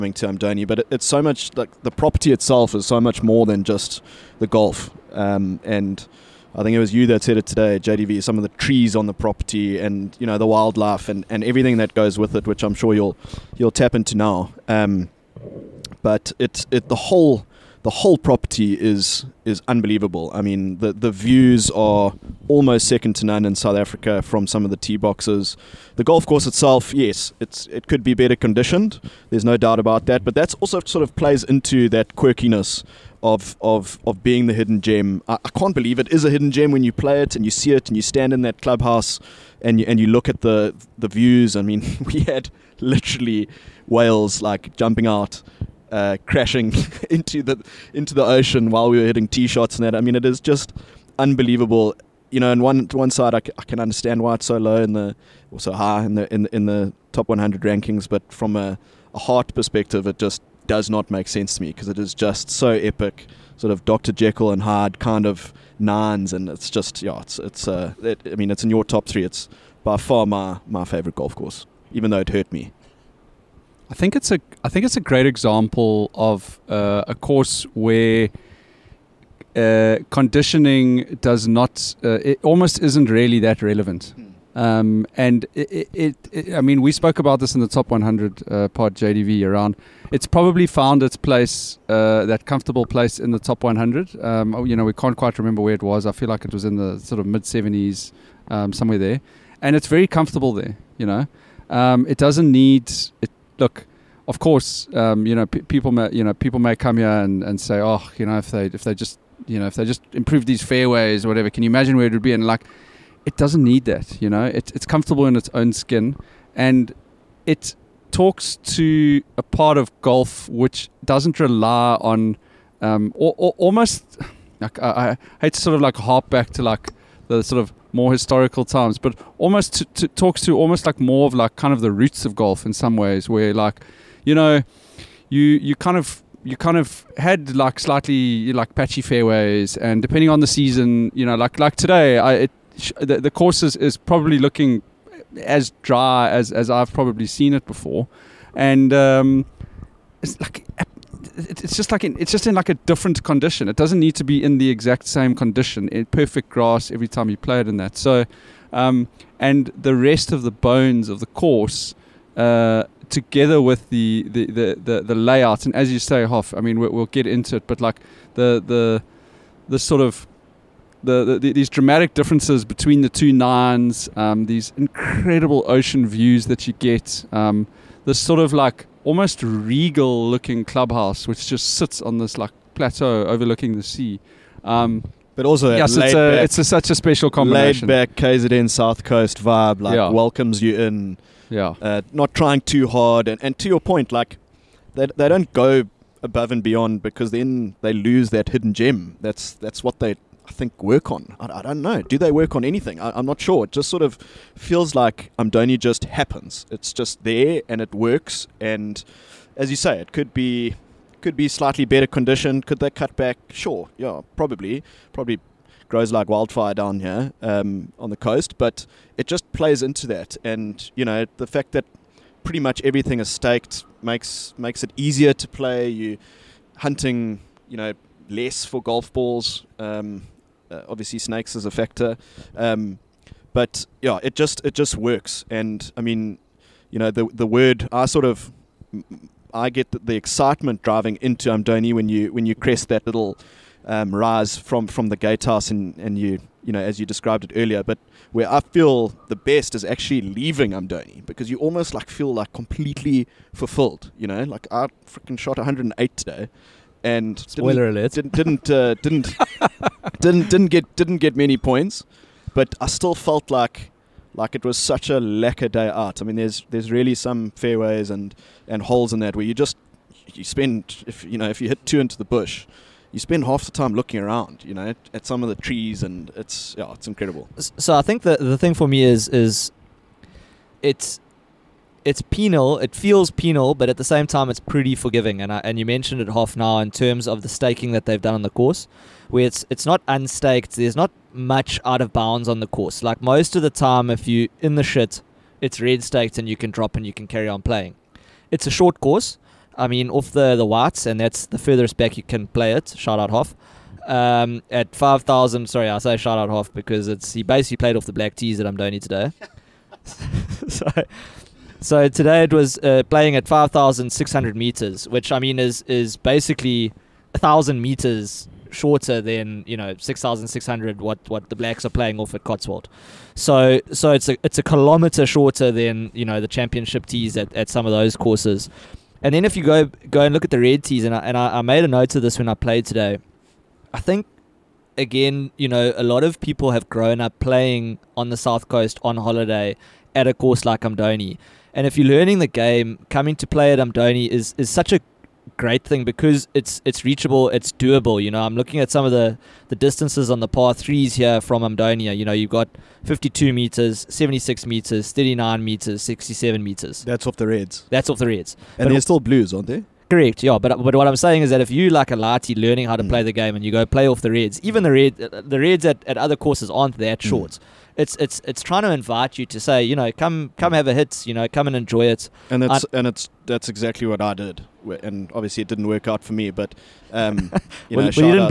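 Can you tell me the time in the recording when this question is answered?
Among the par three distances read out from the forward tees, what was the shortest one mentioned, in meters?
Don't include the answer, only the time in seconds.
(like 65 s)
355 s.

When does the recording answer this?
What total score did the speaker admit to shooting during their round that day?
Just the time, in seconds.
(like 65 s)
255 s.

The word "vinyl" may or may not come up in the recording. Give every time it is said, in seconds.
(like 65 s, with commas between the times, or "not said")
not said.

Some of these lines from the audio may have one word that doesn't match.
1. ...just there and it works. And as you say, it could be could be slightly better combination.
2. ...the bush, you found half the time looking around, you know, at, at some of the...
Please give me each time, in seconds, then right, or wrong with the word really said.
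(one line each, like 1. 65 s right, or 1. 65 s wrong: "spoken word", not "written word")
1. 206 s wrong: "condition", not "combination"
2. 272 s wrong: "spend", not "found".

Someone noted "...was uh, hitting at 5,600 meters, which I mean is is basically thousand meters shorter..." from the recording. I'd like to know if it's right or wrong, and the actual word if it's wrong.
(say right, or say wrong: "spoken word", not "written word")
wrong: "playing", not "hitting".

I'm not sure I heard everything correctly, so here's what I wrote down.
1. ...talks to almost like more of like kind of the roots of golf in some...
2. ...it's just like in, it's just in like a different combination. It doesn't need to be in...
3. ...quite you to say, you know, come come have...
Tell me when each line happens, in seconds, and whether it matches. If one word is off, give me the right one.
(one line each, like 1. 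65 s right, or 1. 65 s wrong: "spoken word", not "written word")
1. 130 s right
2. 151 s wrong: "condition", not "combination"
3. 368 s wrong: "invite", not "quite".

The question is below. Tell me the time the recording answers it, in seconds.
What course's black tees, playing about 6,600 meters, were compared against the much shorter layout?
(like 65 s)
322 s.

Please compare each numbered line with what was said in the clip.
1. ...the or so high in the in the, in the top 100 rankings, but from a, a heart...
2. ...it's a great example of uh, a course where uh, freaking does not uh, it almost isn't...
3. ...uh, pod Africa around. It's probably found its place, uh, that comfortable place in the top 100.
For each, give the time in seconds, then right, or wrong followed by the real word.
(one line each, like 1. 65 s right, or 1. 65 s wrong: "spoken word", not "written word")
1. 54 s right
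2. 74 s wrong: "conditioning", not "freaking"
3. 88 s wrong: "JDV", not "Africa".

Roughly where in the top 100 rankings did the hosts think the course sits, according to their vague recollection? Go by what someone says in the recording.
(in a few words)
Mid 70s.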